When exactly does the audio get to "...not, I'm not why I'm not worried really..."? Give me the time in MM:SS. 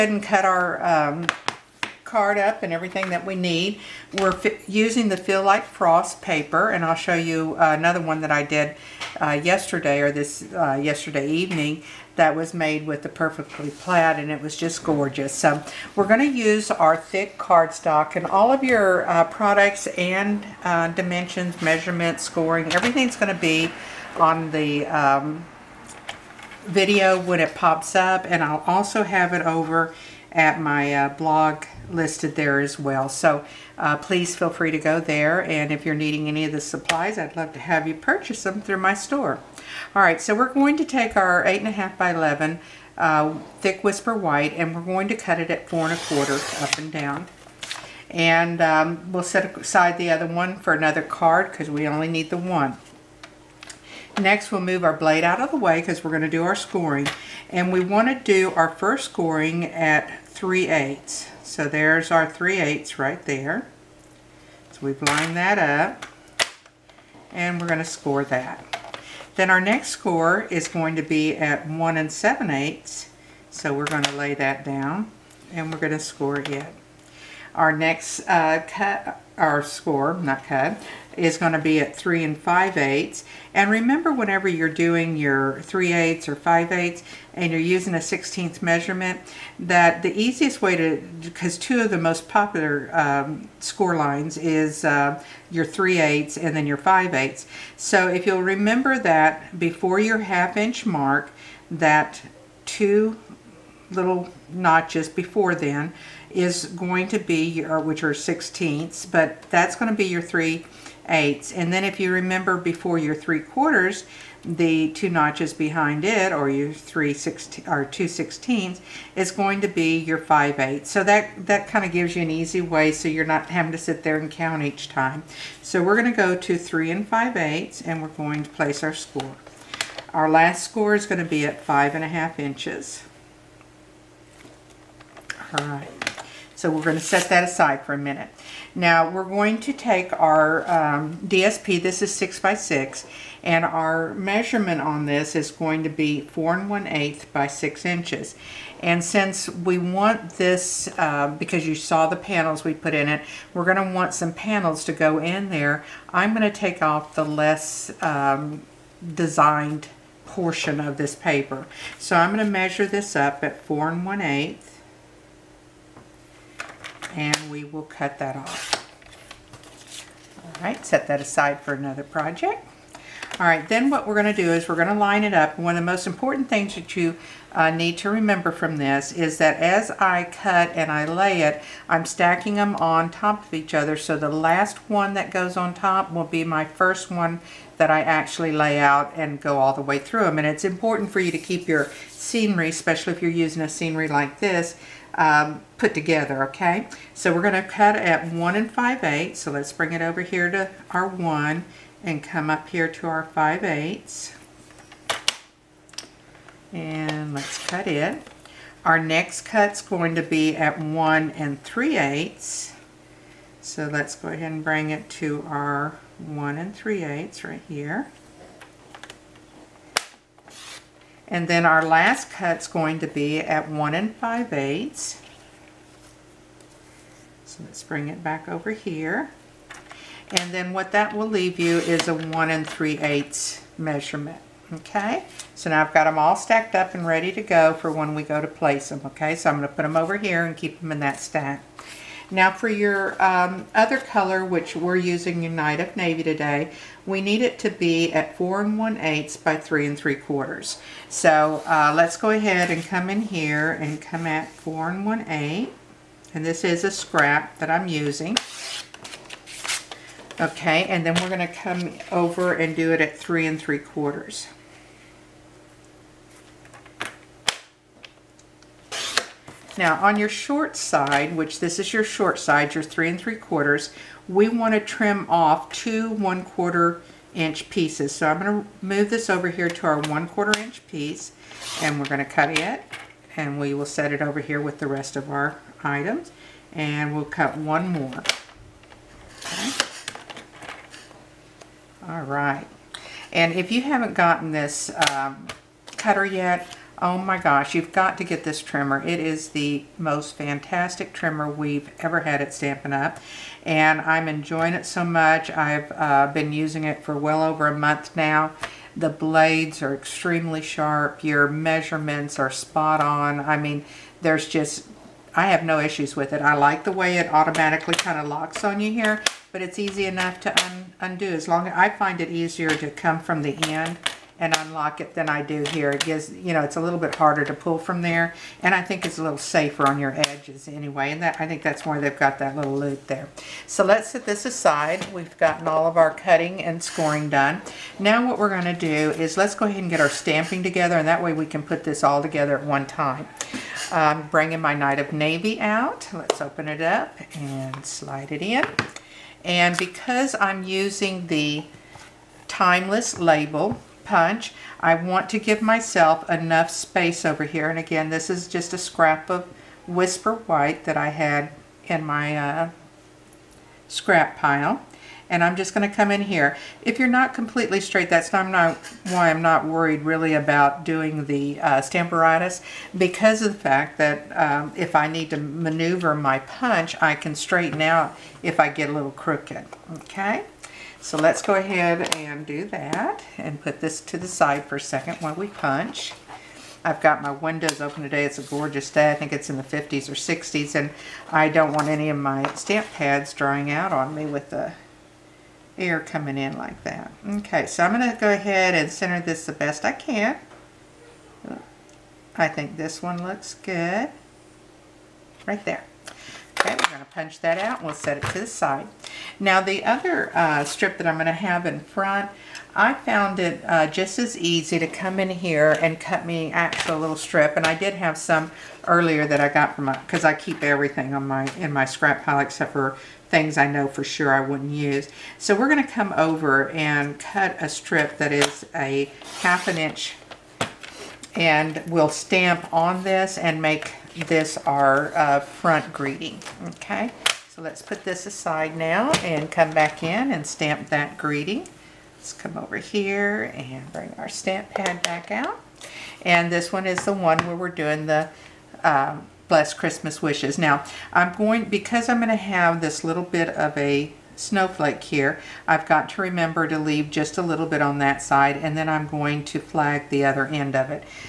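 06:08.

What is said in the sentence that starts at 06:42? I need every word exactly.
I think this one looks good.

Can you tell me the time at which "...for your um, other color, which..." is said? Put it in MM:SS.
04:02.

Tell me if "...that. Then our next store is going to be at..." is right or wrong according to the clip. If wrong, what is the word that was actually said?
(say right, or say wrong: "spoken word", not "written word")
wrong: "score", not "store".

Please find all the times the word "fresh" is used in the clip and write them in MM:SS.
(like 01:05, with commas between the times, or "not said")
not said.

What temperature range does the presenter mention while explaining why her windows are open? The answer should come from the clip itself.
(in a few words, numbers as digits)
50s or 60s.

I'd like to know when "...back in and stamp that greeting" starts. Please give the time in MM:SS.
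07:19.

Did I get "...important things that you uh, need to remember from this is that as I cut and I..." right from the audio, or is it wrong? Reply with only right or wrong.
right.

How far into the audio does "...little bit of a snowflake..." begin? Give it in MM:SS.
07:33.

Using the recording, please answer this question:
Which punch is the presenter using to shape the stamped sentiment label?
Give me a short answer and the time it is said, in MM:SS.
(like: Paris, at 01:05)
Timeless label punch, at 05:52.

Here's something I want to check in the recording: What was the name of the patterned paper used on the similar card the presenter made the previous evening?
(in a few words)
Perfectly Plaid.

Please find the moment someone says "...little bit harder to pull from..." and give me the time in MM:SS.
05:26.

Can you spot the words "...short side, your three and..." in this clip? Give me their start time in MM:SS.
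04:32.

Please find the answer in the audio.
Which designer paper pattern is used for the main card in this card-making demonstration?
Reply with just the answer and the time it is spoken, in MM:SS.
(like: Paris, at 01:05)
Feels Like Frost, at 00:05.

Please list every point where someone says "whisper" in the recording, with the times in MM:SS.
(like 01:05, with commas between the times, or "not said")
00:43, 05:59.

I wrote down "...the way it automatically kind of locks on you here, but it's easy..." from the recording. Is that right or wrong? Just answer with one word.
right.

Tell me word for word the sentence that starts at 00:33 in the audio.
So uh, please feel free to go there.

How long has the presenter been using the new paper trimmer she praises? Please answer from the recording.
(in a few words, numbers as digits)
well over a month.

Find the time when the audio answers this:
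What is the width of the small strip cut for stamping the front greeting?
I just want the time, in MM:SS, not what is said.
07:08.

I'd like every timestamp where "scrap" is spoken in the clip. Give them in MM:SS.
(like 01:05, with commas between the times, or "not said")
04:16, 05:58, 06:03, 07:01.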